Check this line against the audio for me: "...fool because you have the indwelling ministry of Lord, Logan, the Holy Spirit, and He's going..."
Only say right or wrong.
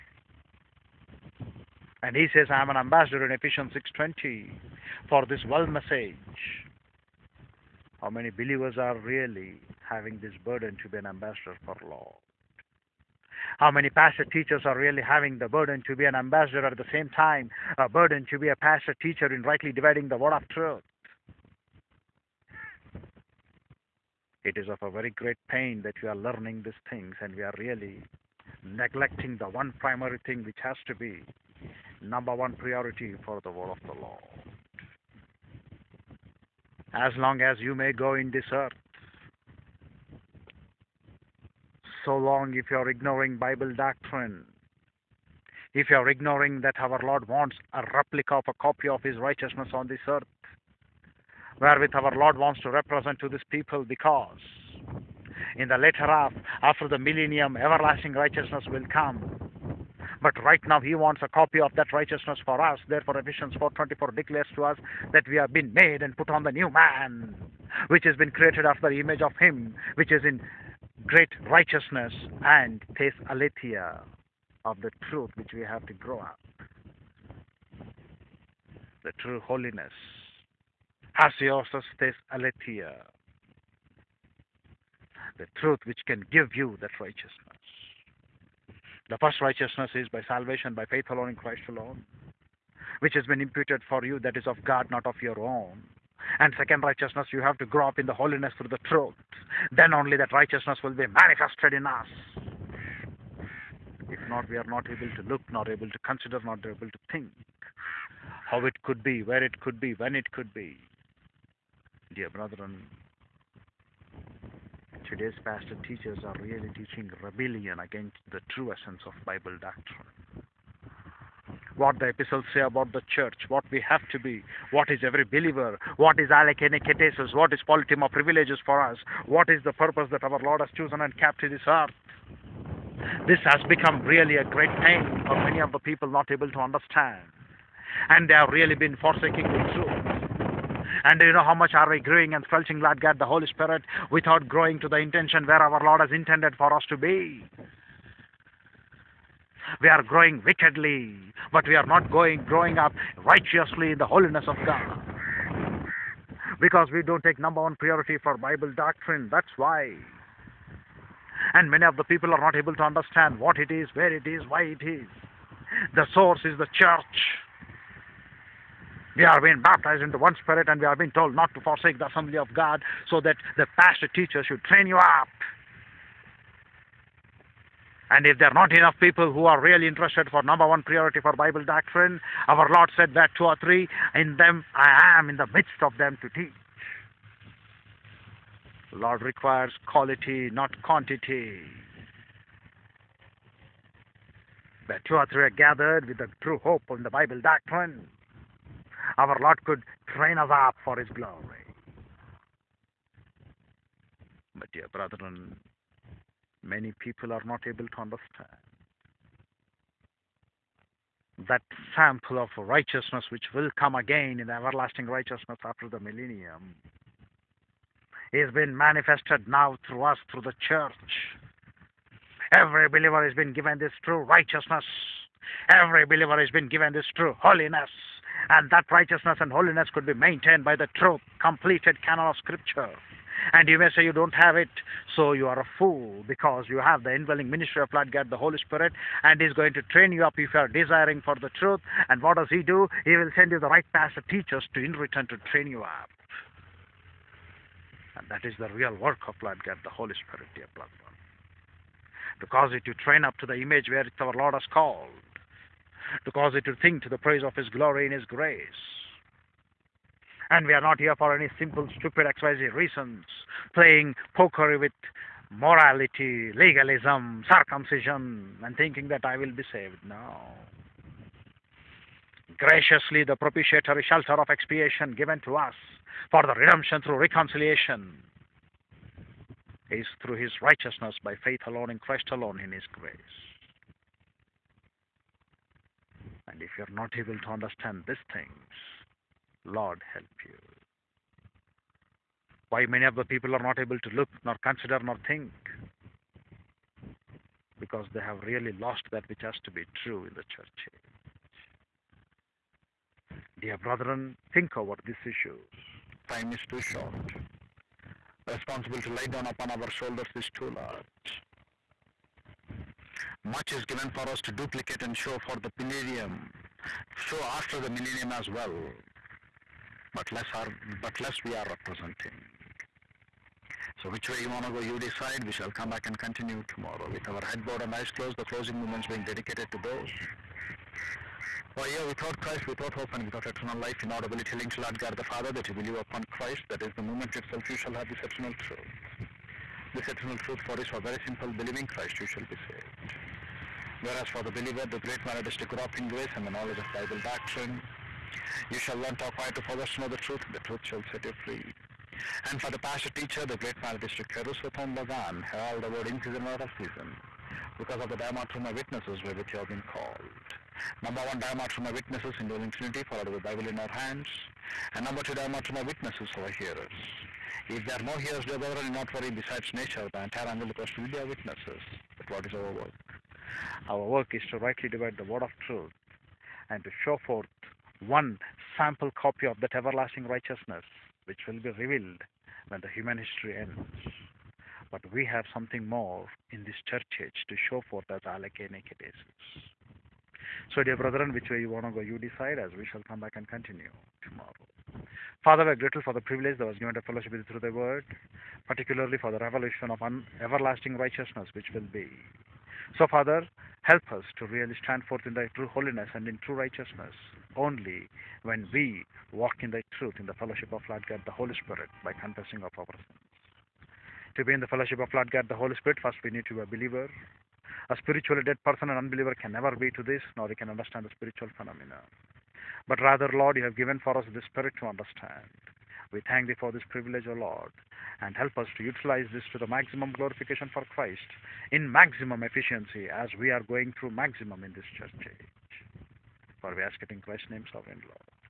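wrong.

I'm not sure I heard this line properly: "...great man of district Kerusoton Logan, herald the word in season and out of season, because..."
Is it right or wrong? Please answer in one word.
right.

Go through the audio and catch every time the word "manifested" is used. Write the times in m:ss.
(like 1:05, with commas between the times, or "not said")
1:41, 3:38.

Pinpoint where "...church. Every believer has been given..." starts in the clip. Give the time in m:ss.
3:40.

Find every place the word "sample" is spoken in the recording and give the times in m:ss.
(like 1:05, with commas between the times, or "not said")
3:31, 6:18.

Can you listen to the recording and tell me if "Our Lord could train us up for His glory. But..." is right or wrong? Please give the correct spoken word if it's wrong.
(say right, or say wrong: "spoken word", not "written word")
right.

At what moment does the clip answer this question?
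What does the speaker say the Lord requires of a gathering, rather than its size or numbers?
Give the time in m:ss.
3:09.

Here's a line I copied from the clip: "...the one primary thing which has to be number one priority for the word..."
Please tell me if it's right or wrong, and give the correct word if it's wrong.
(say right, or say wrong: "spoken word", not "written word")
right.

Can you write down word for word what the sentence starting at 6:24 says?
But we have something more in this church age to show forth as alake nekatesis.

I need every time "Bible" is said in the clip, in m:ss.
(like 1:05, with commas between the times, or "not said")
0:43, 1:59, 2:38, 3:01, 3:17, 5:46, 6:03.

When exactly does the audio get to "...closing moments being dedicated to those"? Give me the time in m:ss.
5:28.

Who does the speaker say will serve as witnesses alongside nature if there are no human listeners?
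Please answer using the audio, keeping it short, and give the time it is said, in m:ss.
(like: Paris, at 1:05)
the entire angelic host, at 6:10.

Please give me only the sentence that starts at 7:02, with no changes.
But rather, Lord, you have given for us the Spirit to understand.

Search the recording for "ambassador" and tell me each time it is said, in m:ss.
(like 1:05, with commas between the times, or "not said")
0:02, 0:11, 0:16.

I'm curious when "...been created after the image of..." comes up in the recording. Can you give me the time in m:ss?
1:08.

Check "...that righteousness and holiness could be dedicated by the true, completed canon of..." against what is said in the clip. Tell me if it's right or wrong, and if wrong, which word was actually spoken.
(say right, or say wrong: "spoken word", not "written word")
wrong: "maintained", not "dedicated".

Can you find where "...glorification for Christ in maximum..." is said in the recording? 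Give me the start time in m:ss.
7:10.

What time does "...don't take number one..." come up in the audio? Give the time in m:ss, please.
2:37.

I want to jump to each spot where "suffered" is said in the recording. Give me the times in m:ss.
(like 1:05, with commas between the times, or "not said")
not said.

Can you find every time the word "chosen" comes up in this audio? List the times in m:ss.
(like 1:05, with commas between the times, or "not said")
2:10.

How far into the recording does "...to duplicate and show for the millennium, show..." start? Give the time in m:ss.
5:14.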